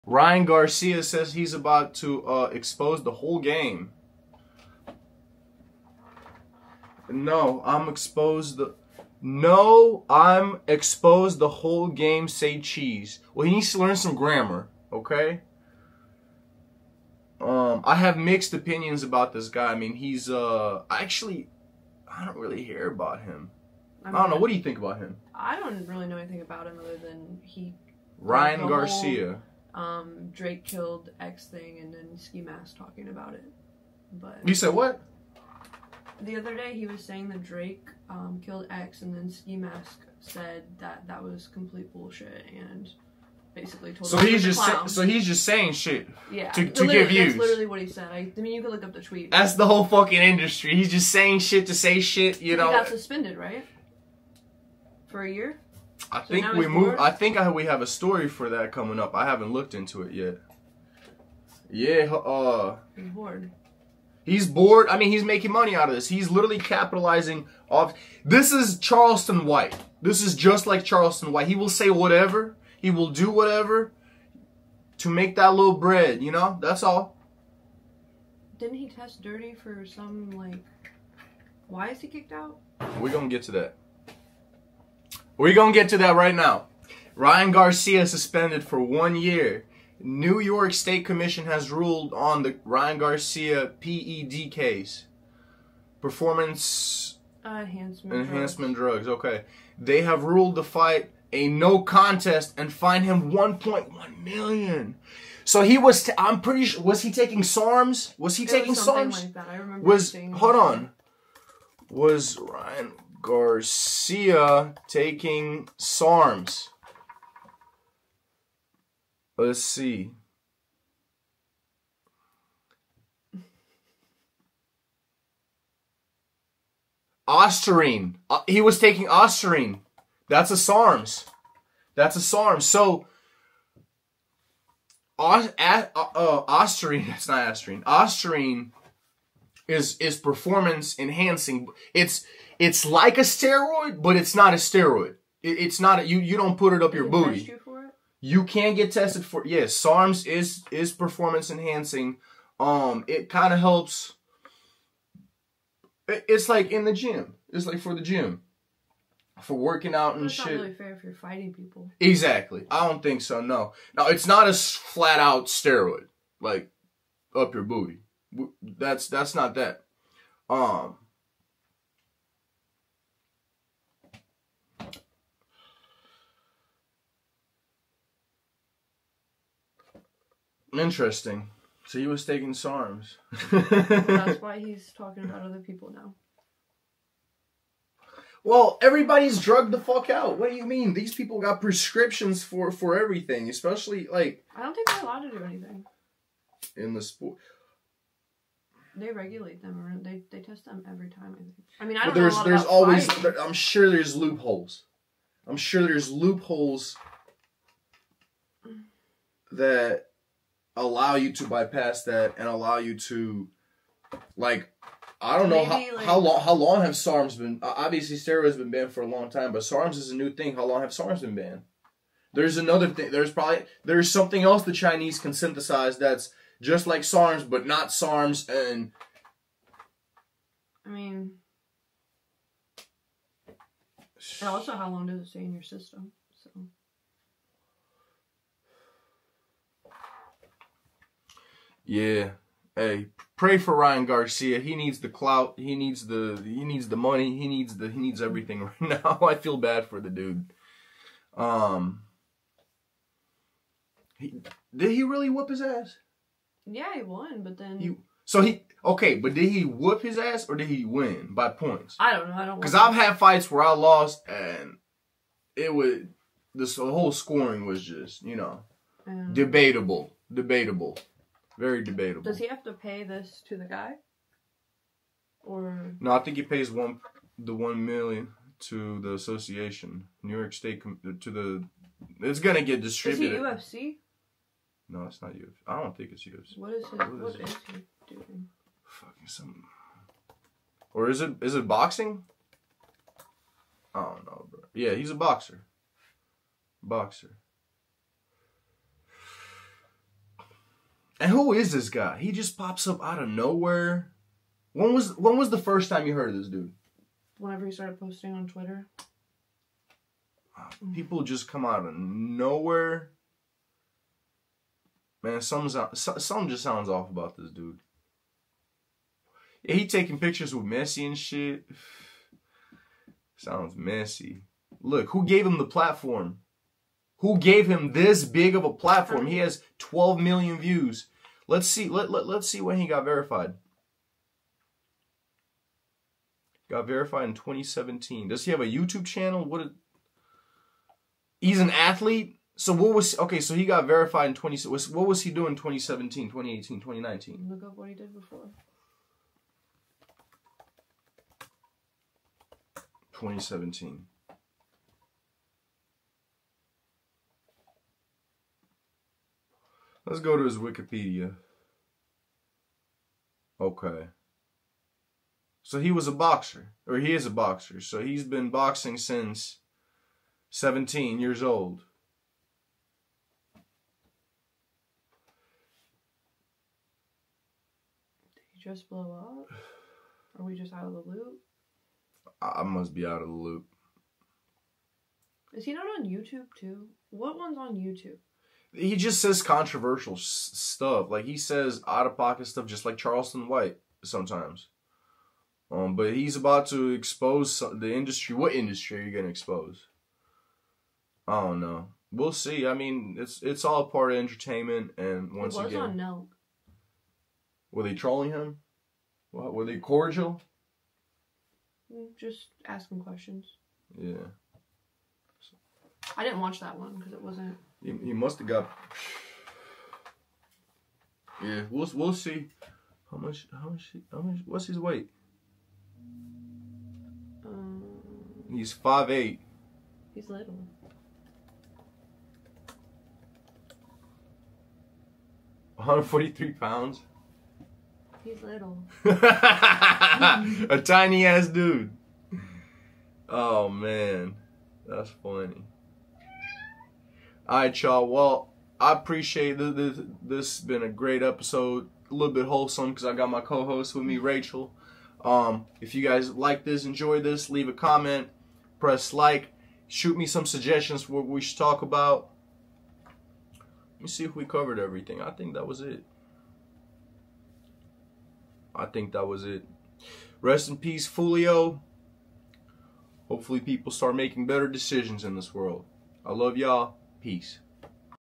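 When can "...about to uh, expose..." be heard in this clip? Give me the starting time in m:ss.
0:01.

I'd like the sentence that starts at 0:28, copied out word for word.
Ryan Garcia um, Drake killed X thing and then Ski Mask talking about it.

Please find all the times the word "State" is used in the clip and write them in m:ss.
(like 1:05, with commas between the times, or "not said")
1:30, 4:40.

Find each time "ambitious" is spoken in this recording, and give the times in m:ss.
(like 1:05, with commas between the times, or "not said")
not said.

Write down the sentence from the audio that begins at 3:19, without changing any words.
Or they they test them every time.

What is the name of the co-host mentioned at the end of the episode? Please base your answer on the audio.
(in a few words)
Rachel.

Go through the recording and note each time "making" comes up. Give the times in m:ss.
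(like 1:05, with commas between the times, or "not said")
1:05, 7:54.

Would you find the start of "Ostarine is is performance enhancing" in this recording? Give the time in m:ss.
2:17.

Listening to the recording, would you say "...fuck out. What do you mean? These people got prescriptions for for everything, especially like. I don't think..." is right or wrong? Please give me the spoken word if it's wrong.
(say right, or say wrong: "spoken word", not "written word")
right.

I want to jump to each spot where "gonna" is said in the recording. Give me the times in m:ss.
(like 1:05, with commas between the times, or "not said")
1:23, 4:42, 6:39.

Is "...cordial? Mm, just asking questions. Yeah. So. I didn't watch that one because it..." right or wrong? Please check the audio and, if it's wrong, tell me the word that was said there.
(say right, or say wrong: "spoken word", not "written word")
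right.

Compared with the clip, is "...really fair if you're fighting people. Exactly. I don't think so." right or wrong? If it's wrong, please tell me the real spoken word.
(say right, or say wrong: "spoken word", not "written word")
right.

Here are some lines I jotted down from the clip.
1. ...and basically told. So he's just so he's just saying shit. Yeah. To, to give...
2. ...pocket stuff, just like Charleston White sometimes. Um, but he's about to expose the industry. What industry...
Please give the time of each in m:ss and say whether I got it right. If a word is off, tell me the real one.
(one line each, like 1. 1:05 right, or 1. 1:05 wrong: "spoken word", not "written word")
1. 0:42 right
2. 6:32 right.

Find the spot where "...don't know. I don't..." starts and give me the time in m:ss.
4:22.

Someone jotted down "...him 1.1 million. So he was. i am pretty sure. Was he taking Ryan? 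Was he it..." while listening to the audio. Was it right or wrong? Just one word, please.
wrong.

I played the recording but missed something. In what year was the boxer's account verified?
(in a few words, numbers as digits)
2017.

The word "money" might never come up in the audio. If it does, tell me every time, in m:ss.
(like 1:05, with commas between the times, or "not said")
1:05, 4:06.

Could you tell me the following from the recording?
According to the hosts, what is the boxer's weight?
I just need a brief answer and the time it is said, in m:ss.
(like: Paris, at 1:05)
143 pounds, at 7:15.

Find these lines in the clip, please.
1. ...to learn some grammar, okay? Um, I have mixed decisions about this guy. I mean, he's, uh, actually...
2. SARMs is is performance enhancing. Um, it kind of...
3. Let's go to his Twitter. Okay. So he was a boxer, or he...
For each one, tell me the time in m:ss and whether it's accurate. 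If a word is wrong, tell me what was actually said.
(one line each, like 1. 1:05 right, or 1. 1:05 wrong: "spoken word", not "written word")
1. 0:13 wrong: "opinions", not "decisions"
2. 2:29 right
3. 6:00 wrong: "Wikipedia", not "Twitter".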